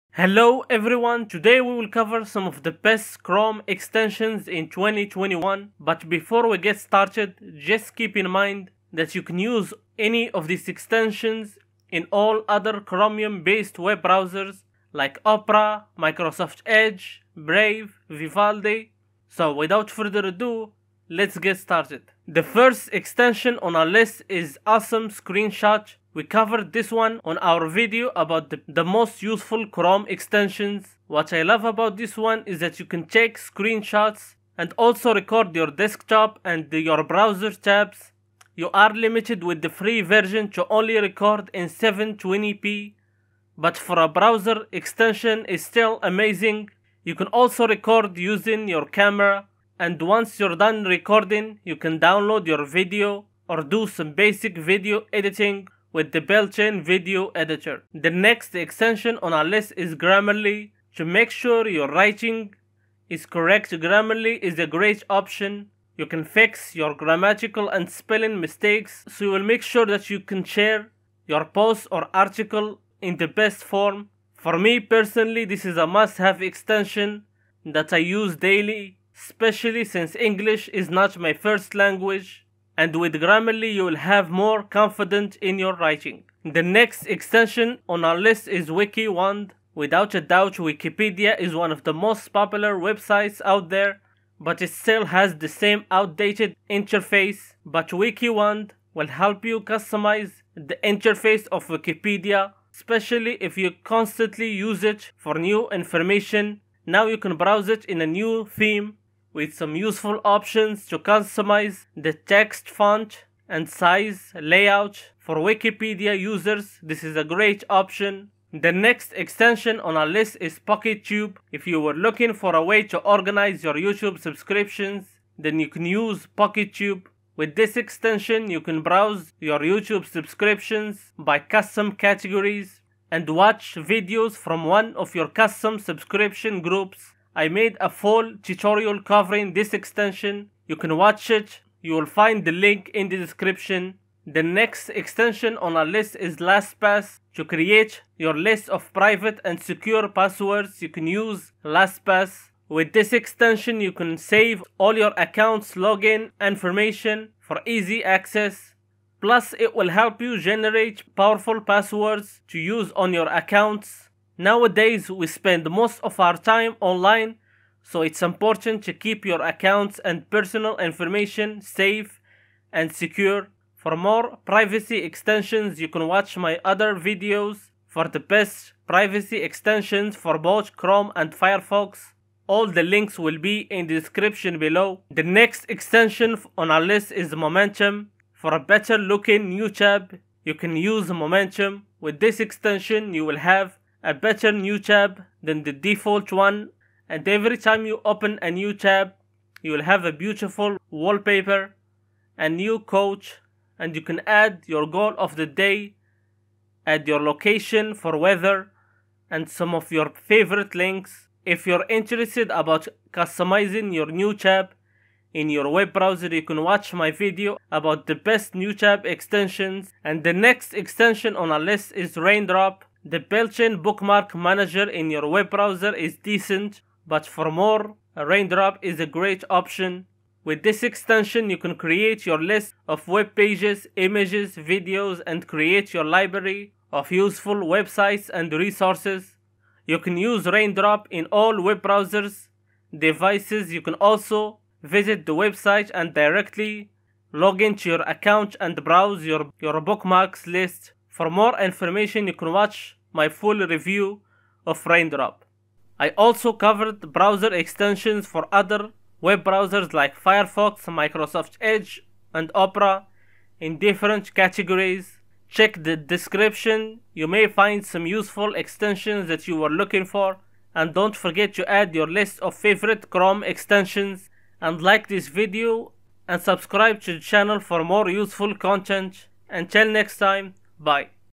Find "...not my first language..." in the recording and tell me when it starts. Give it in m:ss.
1:20.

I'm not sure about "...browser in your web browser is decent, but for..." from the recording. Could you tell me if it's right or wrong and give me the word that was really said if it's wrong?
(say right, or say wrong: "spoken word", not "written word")
wrong: "manager", not "browser".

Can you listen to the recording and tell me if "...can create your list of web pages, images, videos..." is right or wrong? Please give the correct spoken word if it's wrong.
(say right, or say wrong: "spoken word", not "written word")
right.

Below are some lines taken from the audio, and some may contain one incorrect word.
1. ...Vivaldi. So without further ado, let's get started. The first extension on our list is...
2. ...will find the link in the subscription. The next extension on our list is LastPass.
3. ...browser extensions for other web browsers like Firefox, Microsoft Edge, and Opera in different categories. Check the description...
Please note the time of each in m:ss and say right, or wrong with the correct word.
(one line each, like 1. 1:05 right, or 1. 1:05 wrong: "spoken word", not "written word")
1. 0:18 right
2. 2:21 wrong: "description", not "subscription"
3. 4:17 right.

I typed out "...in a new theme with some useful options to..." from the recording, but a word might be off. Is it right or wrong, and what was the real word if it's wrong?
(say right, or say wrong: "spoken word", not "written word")
right.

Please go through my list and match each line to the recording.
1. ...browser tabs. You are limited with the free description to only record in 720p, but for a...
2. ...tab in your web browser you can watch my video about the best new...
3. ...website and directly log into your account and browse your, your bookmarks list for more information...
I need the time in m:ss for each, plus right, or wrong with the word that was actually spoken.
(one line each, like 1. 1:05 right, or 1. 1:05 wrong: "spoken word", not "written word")
1. 0:37 wrong: "version", not "description"
2. 3:34 right
3. 4:05 right.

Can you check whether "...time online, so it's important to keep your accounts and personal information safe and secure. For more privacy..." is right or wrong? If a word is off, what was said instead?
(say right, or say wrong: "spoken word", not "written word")
right.